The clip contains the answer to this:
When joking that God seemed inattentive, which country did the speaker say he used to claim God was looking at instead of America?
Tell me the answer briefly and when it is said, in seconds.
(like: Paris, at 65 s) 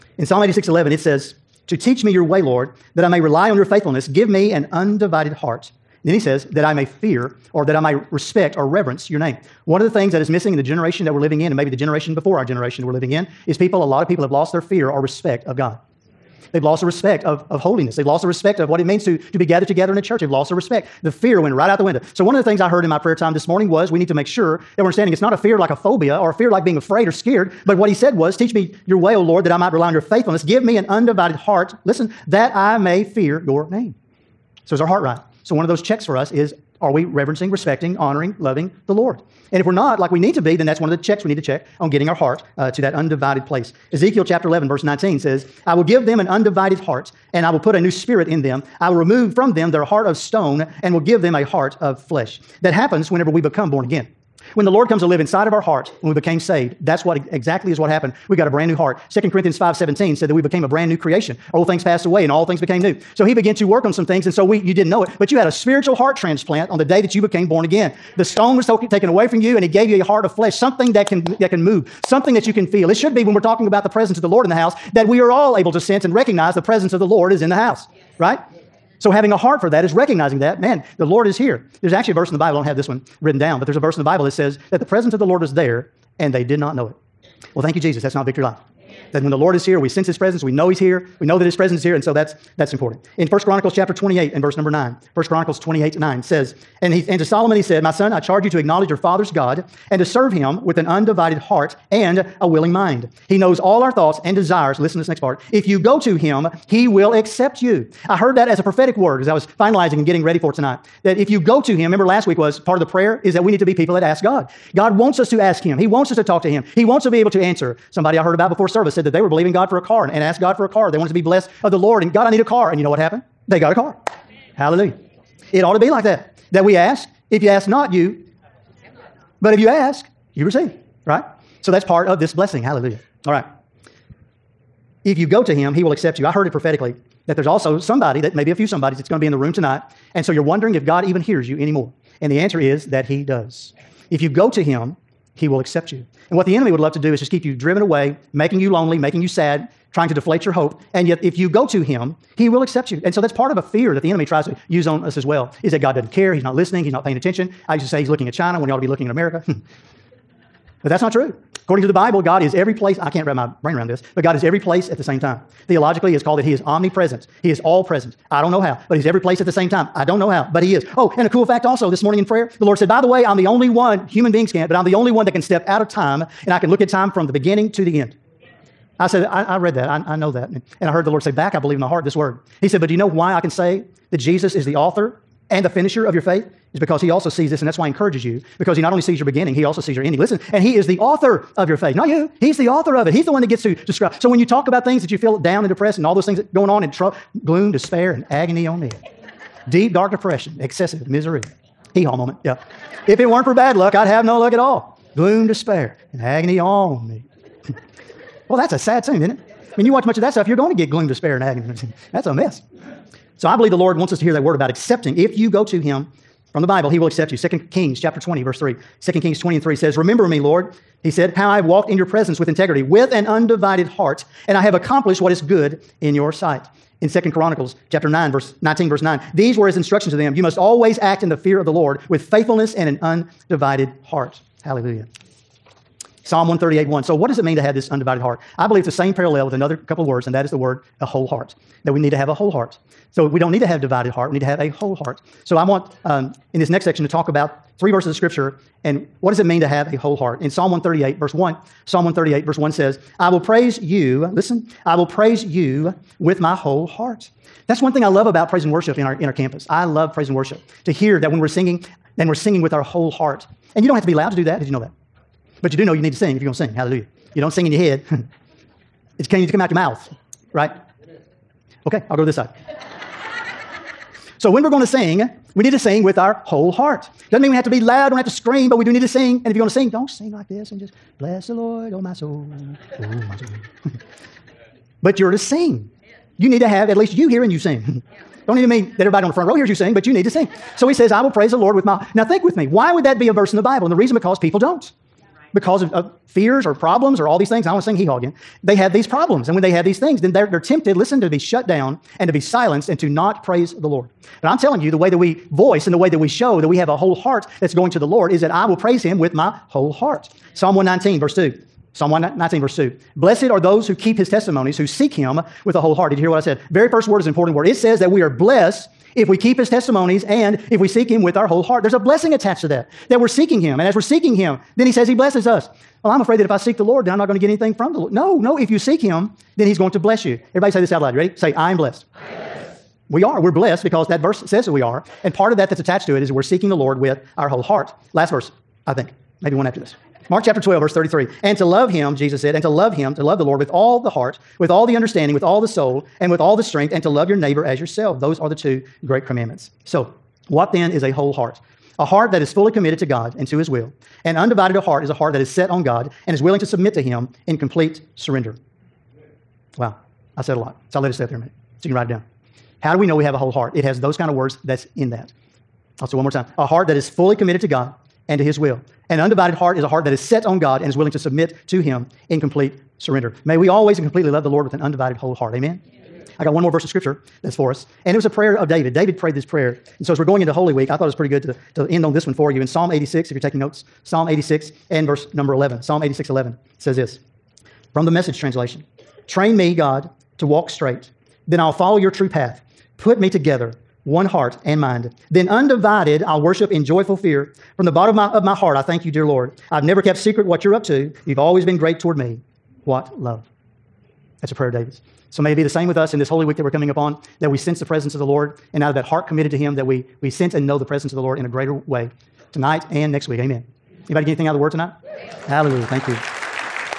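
China, at 158 s.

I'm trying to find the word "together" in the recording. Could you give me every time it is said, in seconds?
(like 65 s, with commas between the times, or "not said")
19 s, 393 s.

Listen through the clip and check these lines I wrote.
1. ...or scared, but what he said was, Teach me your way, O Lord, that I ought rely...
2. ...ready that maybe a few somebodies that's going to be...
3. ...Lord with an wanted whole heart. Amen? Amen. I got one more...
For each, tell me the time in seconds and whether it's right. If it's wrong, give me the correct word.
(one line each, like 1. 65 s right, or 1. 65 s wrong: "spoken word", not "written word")
1. 27 s wrong: "might", not "ought"
2. 137 s wrong: "somebody", not "ready"
3. 374 s wrong: "undivided", not "wanted".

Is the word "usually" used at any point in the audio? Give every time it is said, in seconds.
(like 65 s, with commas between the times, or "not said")
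not said.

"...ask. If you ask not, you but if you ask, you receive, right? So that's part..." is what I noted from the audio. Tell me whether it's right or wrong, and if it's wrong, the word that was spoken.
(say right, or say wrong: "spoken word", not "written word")
right.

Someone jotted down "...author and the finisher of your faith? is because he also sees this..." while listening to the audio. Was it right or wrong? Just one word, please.
right.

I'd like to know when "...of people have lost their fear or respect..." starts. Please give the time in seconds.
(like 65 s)
14 s.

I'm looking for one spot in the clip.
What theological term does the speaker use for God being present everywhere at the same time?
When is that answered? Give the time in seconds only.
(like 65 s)
166 s.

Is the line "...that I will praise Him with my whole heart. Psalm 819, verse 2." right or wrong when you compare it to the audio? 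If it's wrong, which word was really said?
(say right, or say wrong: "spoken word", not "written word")
wrong: "119", not "819".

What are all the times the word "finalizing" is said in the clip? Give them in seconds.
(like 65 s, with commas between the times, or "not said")
109 s.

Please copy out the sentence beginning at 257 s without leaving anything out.
That's one thing I love about praise and worship in our, in our campus.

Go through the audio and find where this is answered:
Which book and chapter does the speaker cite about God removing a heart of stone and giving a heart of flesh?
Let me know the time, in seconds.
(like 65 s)
43 s.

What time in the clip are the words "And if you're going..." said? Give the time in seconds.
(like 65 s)
279 s.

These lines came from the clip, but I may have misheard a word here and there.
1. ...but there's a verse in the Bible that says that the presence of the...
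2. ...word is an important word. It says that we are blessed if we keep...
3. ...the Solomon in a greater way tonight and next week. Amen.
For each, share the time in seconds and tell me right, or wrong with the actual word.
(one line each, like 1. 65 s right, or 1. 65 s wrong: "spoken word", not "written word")
1. 83 s right
2. 317 s right
3. 411 s wrong: "Lord", not "Solomon".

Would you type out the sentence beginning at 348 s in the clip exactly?
Those are the two great commandments.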